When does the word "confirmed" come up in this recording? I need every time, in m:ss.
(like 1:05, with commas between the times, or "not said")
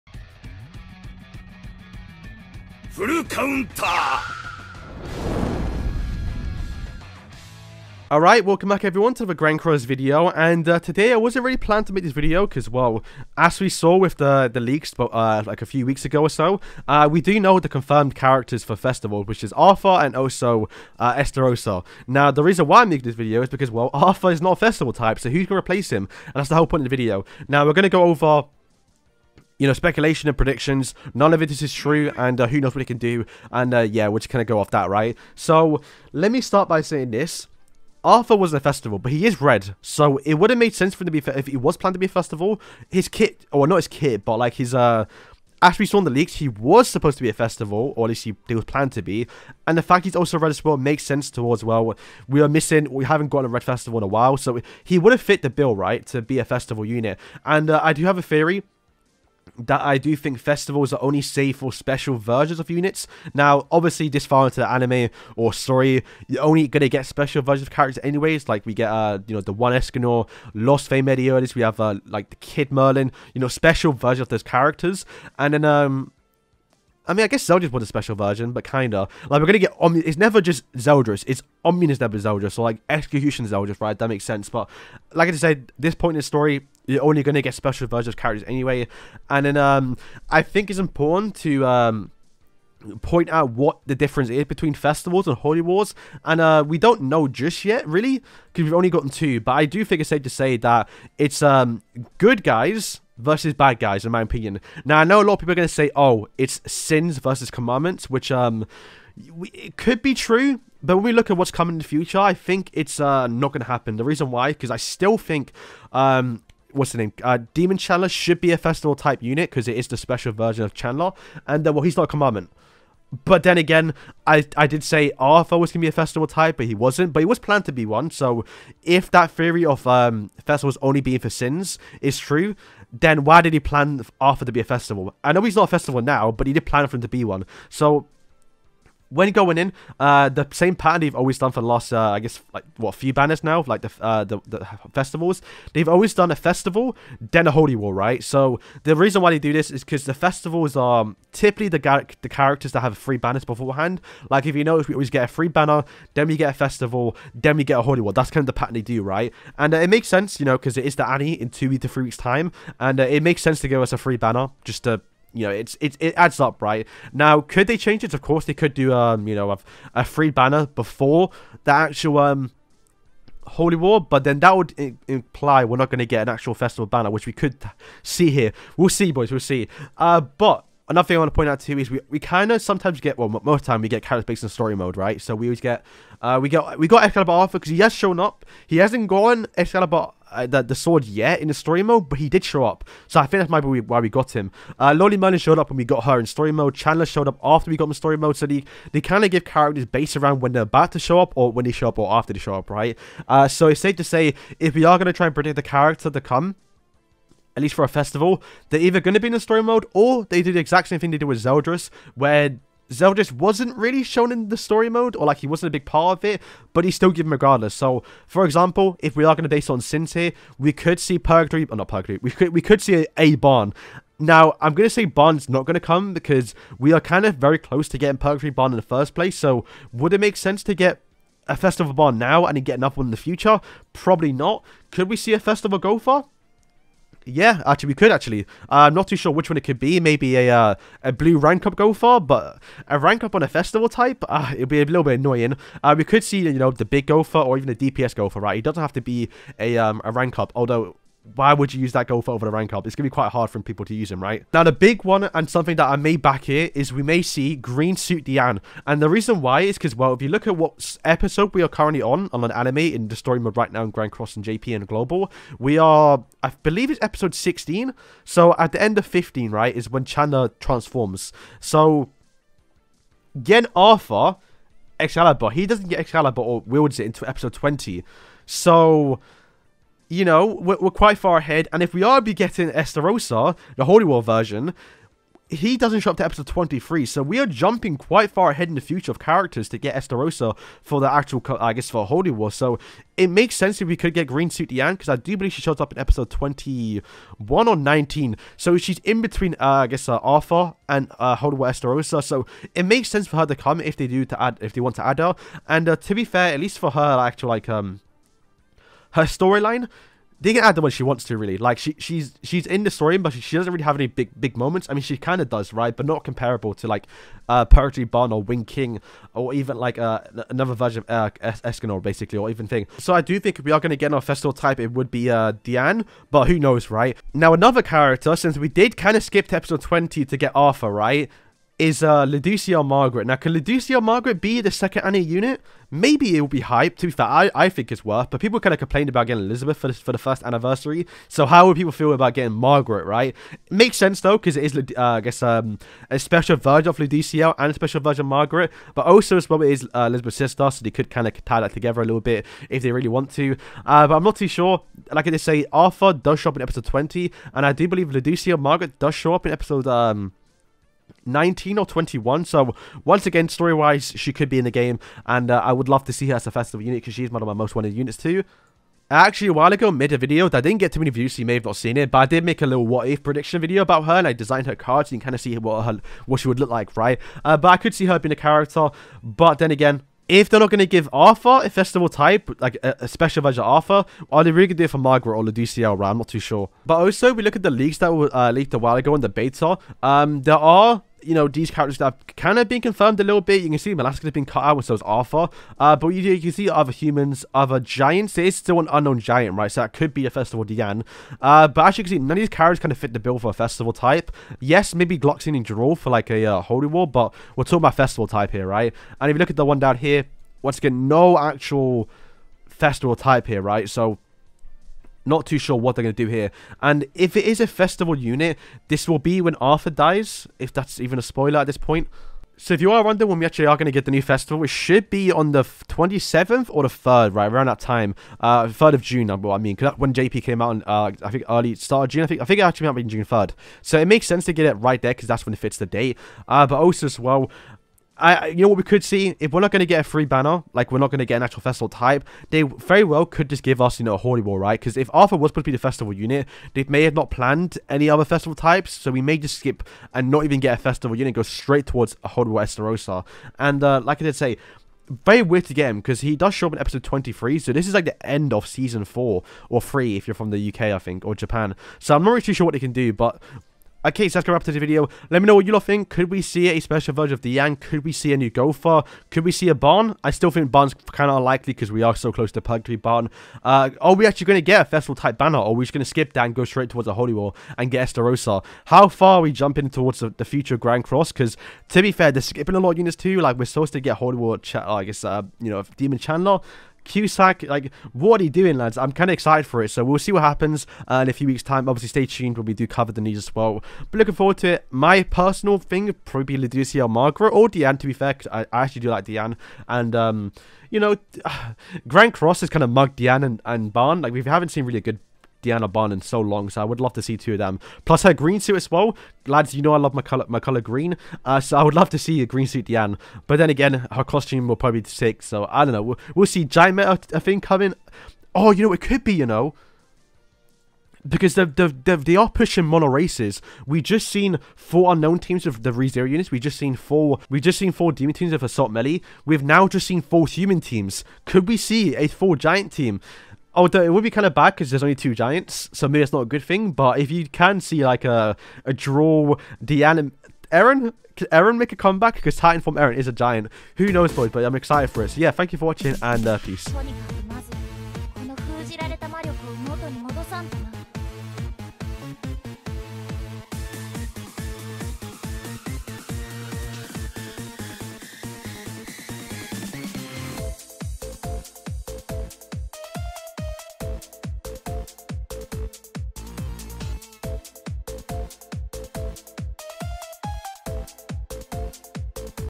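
0:17, 6:32.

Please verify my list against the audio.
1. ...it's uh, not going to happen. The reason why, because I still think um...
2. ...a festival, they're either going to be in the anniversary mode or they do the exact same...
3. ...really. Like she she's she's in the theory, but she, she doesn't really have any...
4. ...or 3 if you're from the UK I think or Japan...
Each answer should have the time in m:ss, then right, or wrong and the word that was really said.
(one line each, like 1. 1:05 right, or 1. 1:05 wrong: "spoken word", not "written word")
1. 1:52 right
2. 3:27 wrong: "story", not "anniversary"
3. 5:11 wrong: "story", not "theory"
4. 7:39 right.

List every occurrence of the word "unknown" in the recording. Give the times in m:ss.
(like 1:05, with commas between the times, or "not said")
6:38, 8:45.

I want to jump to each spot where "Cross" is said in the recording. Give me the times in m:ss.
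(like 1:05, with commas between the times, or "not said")
0:09, 4:24, 8:01, 8:22.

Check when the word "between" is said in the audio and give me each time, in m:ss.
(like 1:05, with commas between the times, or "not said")
1:34, 4:59.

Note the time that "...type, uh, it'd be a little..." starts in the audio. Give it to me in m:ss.
4:03.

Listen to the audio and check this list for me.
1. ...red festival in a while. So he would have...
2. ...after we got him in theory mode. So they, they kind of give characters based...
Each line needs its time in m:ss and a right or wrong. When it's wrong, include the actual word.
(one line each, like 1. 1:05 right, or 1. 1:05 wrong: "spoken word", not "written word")
1. 0:53 right
2. 3:17 wrong: "story", not "theory".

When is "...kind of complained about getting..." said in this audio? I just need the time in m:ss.
5:38.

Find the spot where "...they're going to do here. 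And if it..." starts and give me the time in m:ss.
6:55.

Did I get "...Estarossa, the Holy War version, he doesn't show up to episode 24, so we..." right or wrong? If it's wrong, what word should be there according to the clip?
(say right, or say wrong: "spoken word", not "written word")
wrong: "23", not "24".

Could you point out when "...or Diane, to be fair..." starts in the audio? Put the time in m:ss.
8:17.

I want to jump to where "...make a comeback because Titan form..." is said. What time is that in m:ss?
9:01.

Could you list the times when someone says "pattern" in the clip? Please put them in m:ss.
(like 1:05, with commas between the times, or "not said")
2:20, 2:38.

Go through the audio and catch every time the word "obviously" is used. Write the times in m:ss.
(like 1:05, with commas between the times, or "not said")
1:03, 8:11.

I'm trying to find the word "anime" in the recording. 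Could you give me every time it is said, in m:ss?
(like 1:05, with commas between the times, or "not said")
1:04, 4:22.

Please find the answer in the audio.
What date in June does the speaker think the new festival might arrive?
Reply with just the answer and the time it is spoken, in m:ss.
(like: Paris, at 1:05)
June 3, at 7:13.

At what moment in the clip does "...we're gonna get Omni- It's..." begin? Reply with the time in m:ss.
1:19.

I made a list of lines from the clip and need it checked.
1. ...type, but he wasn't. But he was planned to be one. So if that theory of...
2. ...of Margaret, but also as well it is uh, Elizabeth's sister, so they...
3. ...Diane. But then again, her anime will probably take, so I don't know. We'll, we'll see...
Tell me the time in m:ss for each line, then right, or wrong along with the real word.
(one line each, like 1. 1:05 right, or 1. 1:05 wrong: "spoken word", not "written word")
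1. 2:06 right
2. 5:48 right
3. 8:32 wrong: "costume", not "anime".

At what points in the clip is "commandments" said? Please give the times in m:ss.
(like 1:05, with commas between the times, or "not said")
1:47, 2:02.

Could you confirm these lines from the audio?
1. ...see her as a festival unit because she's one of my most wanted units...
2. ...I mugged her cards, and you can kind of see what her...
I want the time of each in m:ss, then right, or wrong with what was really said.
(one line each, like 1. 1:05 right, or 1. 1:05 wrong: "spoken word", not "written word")
1. 6:06 right
2. 6:14 wrong: "designed", not "mugged".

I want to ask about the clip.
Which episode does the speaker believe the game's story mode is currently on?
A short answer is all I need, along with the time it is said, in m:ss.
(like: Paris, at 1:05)
16, at 4:26.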